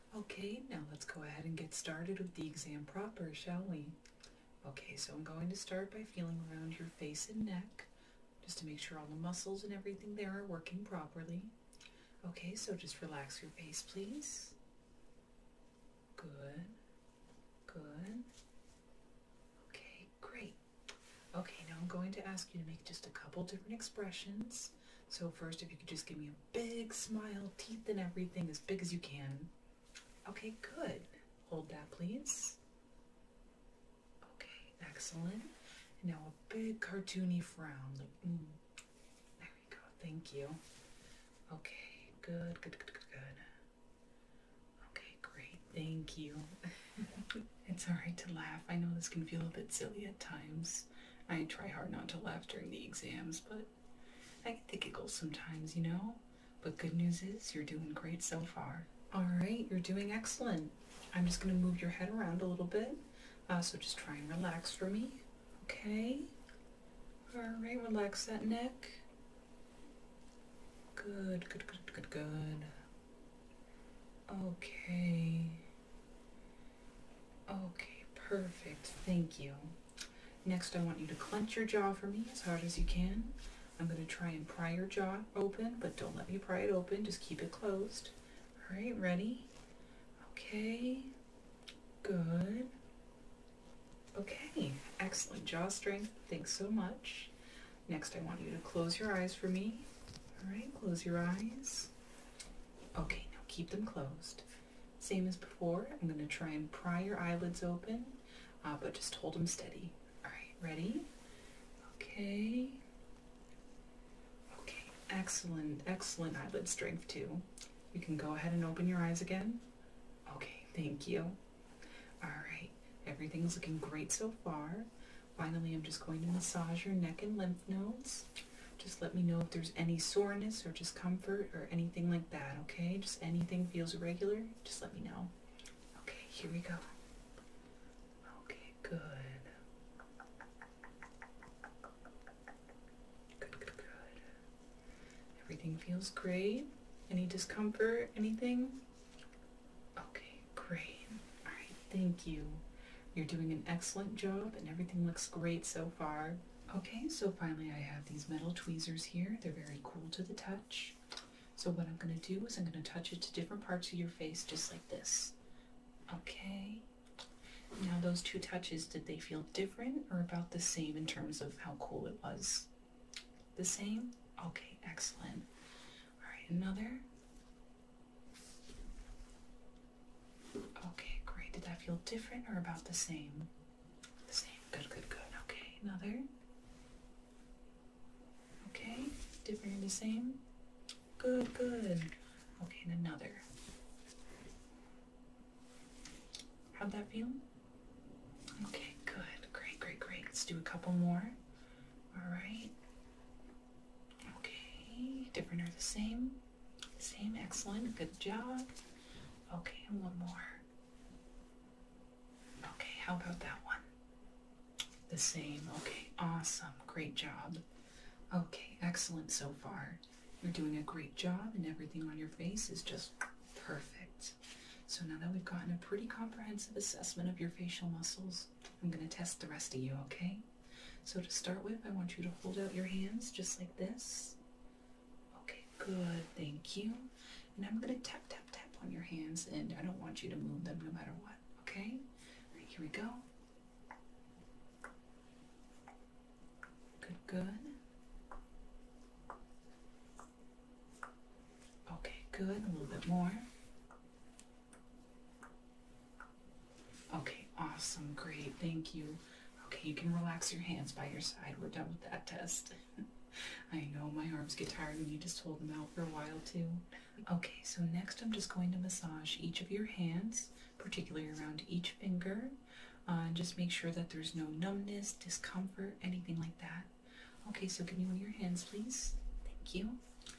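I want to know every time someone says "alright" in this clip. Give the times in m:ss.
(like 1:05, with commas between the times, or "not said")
0:47, 0:59, 1:07, 1:50, 2:02.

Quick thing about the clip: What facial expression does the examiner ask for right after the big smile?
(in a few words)
cartoony frown.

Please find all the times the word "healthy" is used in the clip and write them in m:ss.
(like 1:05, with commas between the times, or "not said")
not said.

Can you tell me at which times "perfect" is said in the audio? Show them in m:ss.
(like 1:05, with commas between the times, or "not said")
1:18, 3:43.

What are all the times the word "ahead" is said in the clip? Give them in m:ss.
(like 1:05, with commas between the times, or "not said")
0:01, 1:58.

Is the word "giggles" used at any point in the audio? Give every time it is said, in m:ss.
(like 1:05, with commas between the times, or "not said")
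0:54.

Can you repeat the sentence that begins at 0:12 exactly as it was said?
Okay, so just relax your face, please.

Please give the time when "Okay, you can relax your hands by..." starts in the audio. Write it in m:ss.
4:19.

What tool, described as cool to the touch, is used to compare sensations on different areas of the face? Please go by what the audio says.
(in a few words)
metal tweezers.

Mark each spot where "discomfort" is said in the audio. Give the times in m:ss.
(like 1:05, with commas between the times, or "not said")
2:10, 2:27, 4:35.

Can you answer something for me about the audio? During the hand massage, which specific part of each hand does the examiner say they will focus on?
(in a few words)
each finger.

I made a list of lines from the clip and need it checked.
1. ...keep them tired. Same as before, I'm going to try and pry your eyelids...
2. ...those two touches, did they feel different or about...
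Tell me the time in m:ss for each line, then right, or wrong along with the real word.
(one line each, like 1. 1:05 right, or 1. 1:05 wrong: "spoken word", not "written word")
1. 1:43 wrong: "closed", not "tired"
2. 2:48 right.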